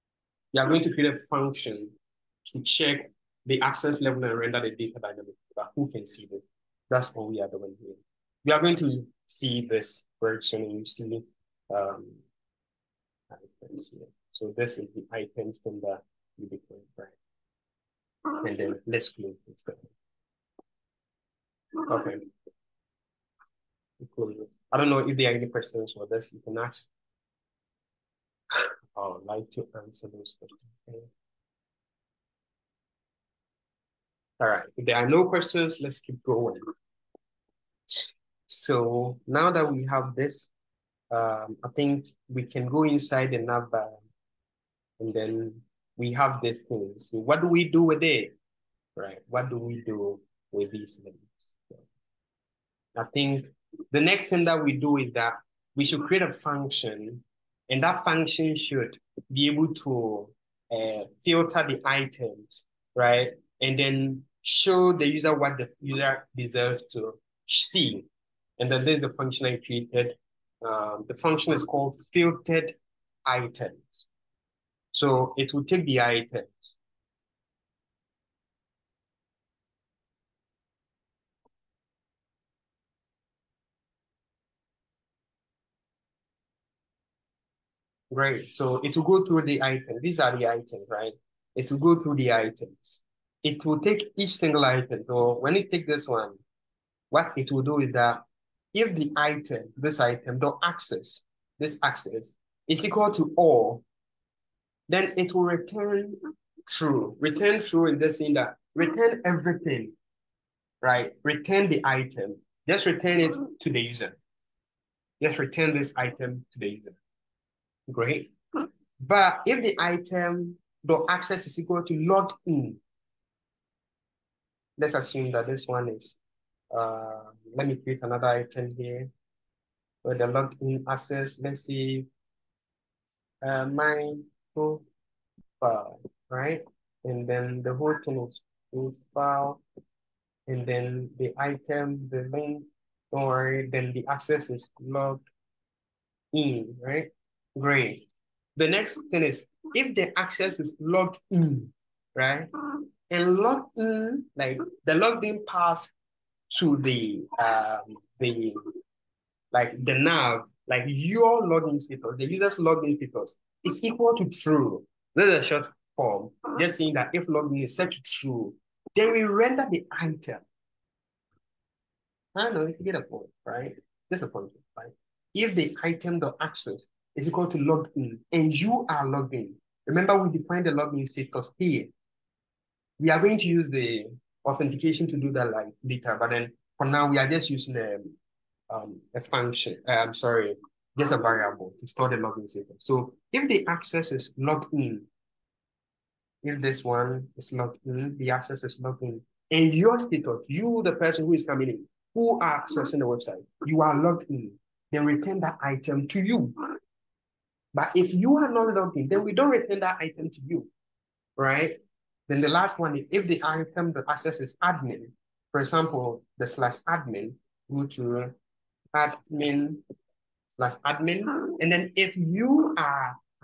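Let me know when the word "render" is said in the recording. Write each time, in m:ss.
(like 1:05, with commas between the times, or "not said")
0:04, 2:49.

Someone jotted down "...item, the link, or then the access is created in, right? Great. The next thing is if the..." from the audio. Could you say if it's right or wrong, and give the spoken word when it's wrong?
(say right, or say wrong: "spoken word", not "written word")
wrong: "logged", not "created".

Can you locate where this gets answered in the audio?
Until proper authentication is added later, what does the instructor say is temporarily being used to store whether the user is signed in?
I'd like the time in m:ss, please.
3:11.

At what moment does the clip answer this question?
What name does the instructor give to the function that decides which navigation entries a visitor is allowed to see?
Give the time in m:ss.
1:12.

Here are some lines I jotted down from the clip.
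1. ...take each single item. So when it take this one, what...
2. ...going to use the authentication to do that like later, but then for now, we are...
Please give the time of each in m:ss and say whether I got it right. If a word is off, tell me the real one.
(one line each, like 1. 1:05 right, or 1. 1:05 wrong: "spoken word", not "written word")
1. 1:33 right
2. 3:03 right.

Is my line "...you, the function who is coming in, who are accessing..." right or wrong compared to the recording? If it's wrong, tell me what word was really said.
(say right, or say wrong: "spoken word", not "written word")
wrong: "person", not "function".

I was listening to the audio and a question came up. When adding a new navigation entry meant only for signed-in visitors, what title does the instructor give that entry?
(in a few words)
My profile.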